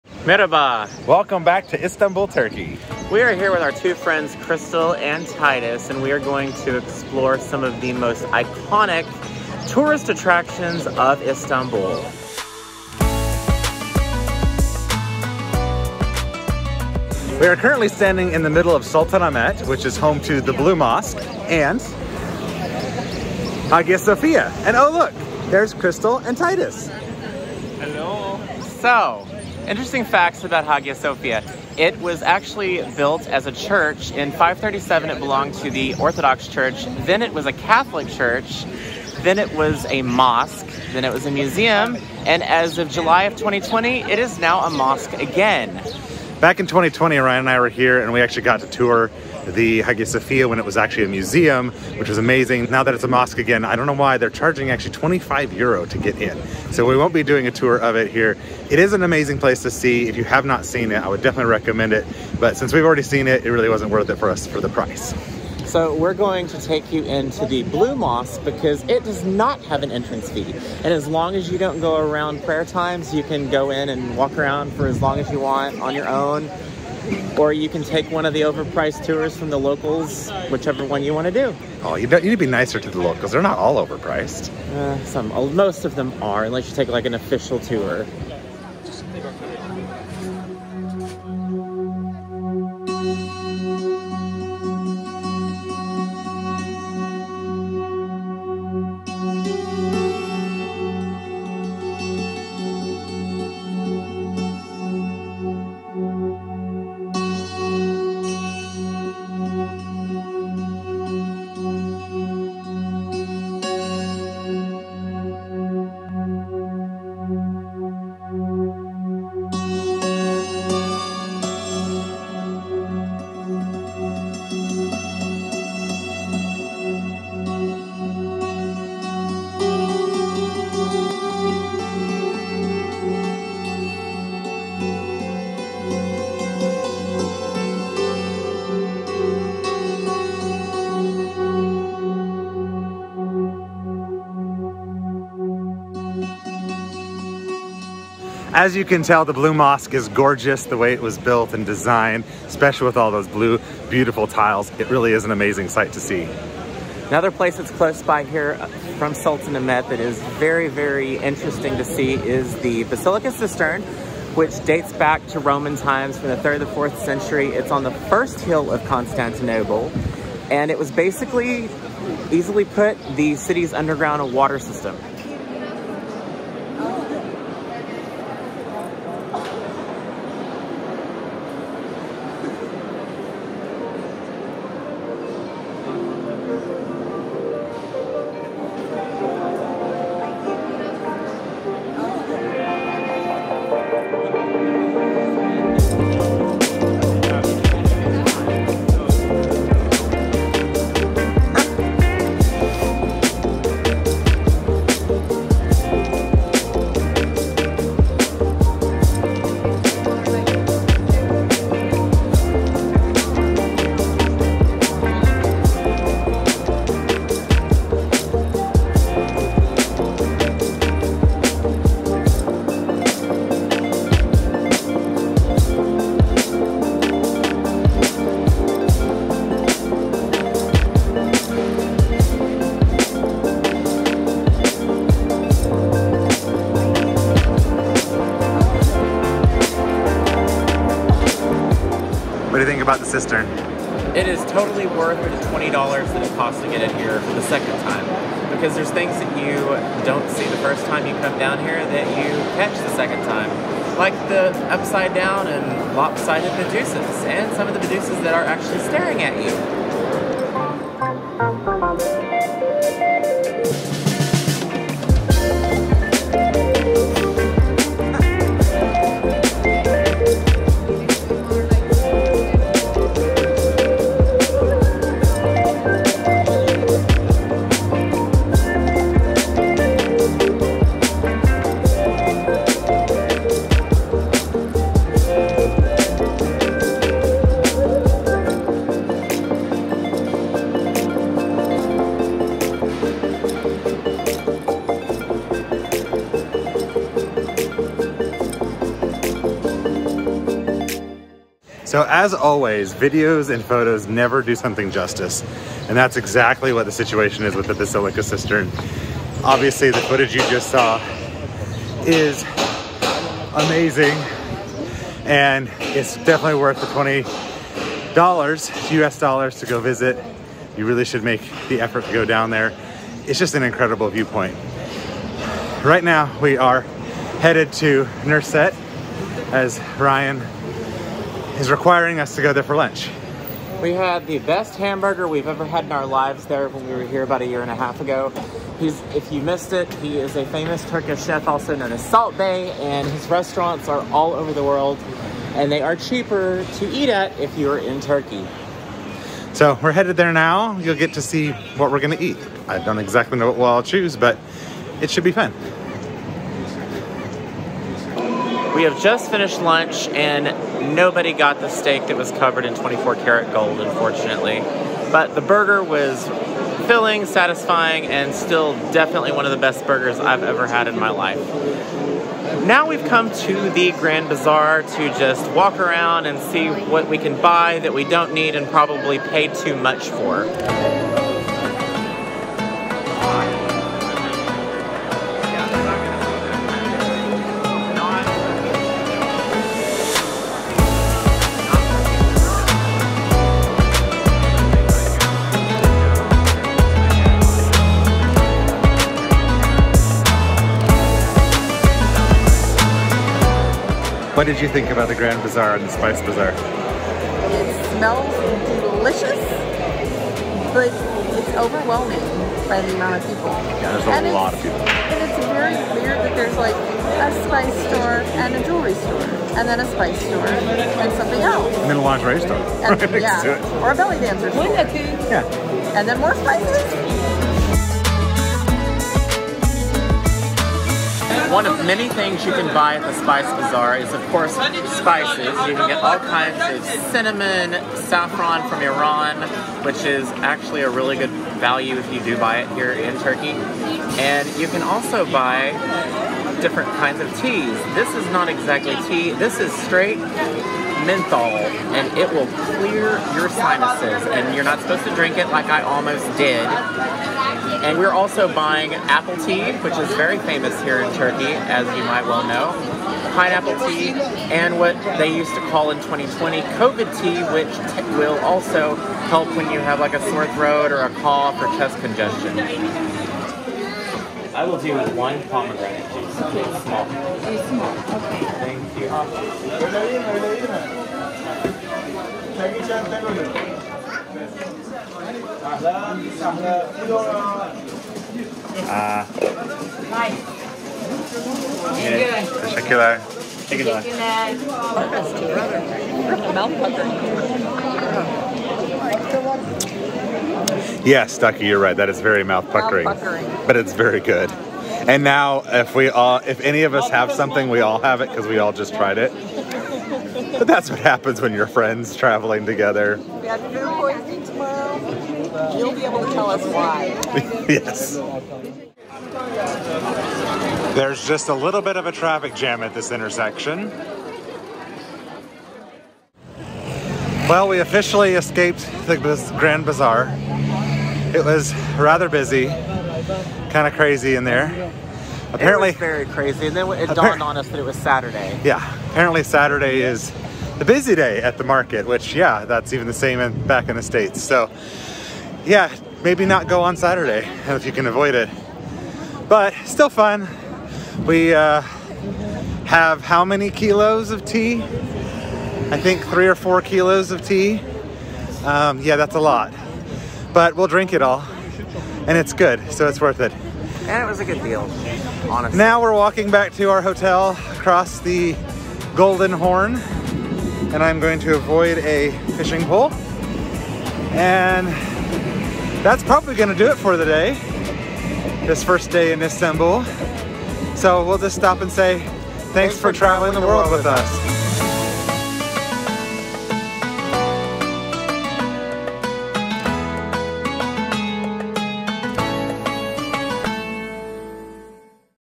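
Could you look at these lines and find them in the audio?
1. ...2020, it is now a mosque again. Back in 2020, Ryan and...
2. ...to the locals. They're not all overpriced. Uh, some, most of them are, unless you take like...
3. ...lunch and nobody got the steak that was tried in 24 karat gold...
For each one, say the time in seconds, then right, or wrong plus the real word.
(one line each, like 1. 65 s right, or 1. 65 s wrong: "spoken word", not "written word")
1. 43 s right
2. 82 s right
3. 359 s wrong: "covered", not "tried".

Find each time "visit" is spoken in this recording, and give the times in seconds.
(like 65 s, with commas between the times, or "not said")
319 s.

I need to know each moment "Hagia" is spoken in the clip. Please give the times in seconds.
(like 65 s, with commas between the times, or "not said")
23 s, 30 s, 49 s.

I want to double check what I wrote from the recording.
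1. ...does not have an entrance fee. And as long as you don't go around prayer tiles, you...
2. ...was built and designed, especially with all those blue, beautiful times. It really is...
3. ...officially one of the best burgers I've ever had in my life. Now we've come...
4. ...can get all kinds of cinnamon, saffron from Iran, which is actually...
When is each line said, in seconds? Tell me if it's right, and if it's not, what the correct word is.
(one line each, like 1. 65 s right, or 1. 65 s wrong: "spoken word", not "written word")
1. 69 s wrong: "times", not "tiles"
2. 151 s wrong: "tiles", not "times"
3. 368 s wrong: "definitely", not "officially"
4. 435 s right.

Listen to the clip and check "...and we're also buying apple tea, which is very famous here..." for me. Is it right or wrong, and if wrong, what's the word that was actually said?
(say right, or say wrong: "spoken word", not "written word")
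right.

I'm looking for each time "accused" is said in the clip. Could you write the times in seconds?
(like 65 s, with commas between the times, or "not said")
not said.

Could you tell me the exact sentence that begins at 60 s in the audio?
If you have not seen it, I would definitely recommend it.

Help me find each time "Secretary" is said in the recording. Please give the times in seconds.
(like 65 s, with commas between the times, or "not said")
not said.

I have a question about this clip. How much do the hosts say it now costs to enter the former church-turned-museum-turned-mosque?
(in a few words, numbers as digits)
25 euro.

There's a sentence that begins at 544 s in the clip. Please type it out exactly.
So yeah, maybe not go on Saturday if you can avoid it.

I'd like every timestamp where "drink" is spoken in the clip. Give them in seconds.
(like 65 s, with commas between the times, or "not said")
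455 s, 560 s.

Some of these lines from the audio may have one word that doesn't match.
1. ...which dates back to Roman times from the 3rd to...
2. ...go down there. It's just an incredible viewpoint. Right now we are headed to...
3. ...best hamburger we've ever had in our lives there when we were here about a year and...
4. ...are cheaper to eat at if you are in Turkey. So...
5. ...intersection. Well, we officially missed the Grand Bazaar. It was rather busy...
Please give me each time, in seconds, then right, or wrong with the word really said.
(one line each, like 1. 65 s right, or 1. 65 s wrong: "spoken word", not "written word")
1. 164 s right
2. 322 s right
3. 334 s right
4. 345 s right
5. 523 s wrong: "escaped", not "missed".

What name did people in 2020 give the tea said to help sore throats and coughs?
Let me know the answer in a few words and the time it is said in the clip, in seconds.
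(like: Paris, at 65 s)
COVID tea, at 466 s.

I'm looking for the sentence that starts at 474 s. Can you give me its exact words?
I will do one pomegranate juice.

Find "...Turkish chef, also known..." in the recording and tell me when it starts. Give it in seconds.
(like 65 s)
340 s.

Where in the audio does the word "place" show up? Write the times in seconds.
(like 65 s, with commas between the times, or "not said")
59 s, 157 s.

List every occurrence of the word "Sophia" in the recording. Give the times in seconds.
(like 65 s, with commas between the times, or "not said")
23 s, 30 s, 50 s.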